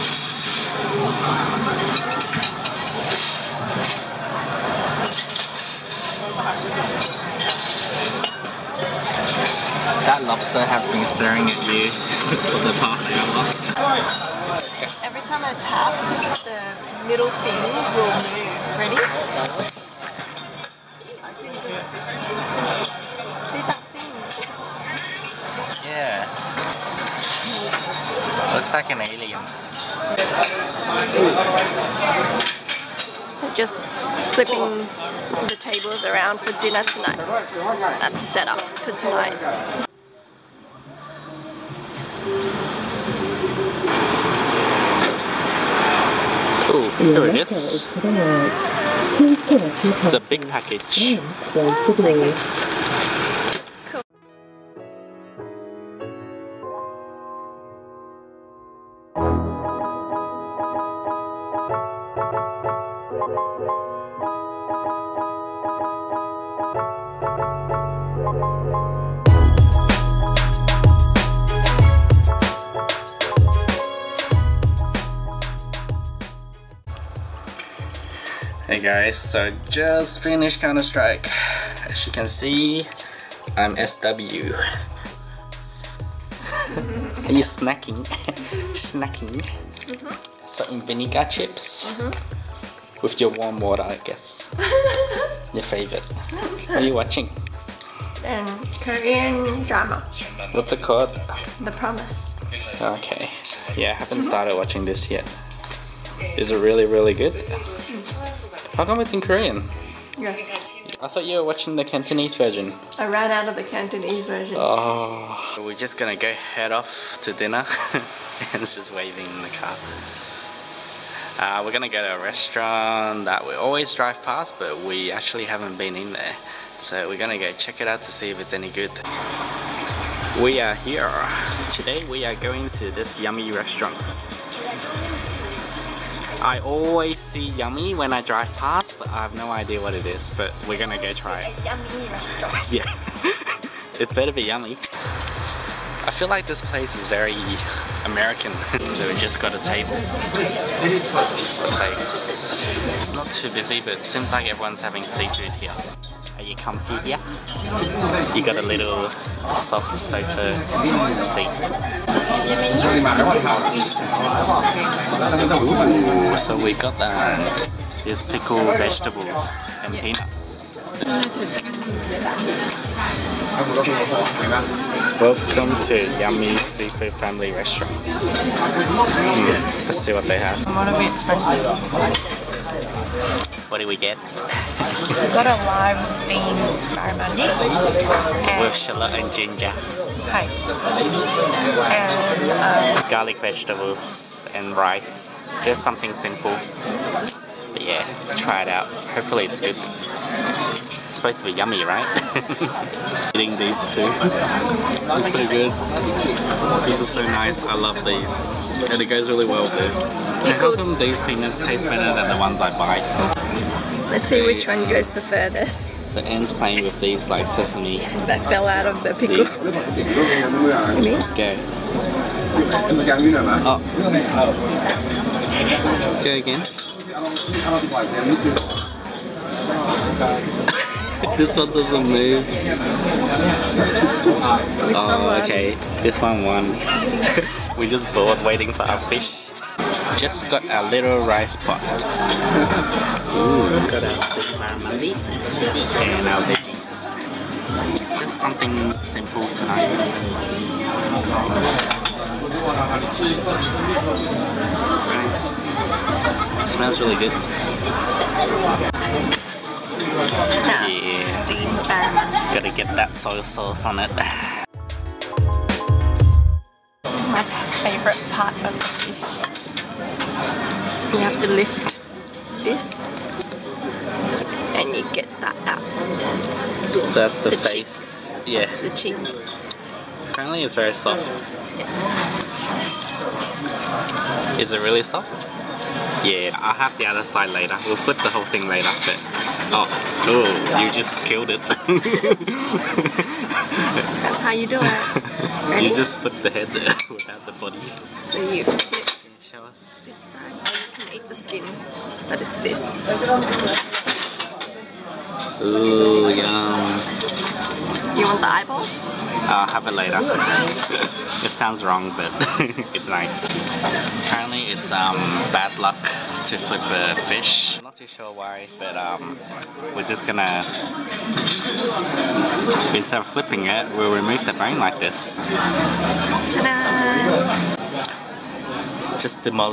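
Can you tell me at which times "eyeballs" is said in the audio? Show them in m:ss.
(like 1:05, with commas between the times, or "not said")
5:08.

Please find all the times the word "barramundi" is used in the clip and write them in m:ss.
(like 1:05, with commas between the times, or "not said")
3:06, 4:04.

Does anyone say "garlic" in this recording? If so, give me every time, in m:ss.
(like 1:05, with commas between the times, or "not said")
3:13.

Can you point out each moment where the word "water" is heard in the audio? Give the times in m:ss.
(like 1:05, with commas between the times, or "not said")
1:33.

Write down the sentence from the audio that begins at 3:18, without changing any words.
Hopefully it's good supposed to be yummy, right?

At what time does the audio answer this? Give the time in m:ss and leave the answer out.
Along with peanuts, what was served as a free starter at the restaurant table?
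2:48.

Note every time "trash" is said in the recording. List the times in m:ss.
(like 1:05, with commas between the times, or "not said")
not said.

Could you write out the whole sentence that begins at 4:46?
Yeah, I'll have the other side later.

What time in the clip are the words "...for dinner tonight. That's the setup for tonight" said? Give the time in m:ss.
0:36.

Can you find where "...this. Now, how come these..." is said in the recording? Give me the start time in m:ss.
3:29.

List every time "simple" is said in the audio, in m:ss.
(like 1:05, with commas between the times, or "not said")
3:16, 4:09.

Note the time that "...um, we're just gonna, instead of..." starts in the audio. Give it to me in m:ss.
5:18.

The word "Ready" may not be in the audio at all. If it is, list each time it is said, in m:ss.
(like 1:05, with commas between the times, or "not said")
0:18, 4:55.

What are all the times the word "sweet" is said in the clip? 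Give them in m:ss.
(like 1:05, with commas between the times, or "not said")
4:04.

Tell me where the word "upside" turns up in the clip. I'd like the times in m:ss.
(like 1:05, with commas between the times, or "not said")
not said.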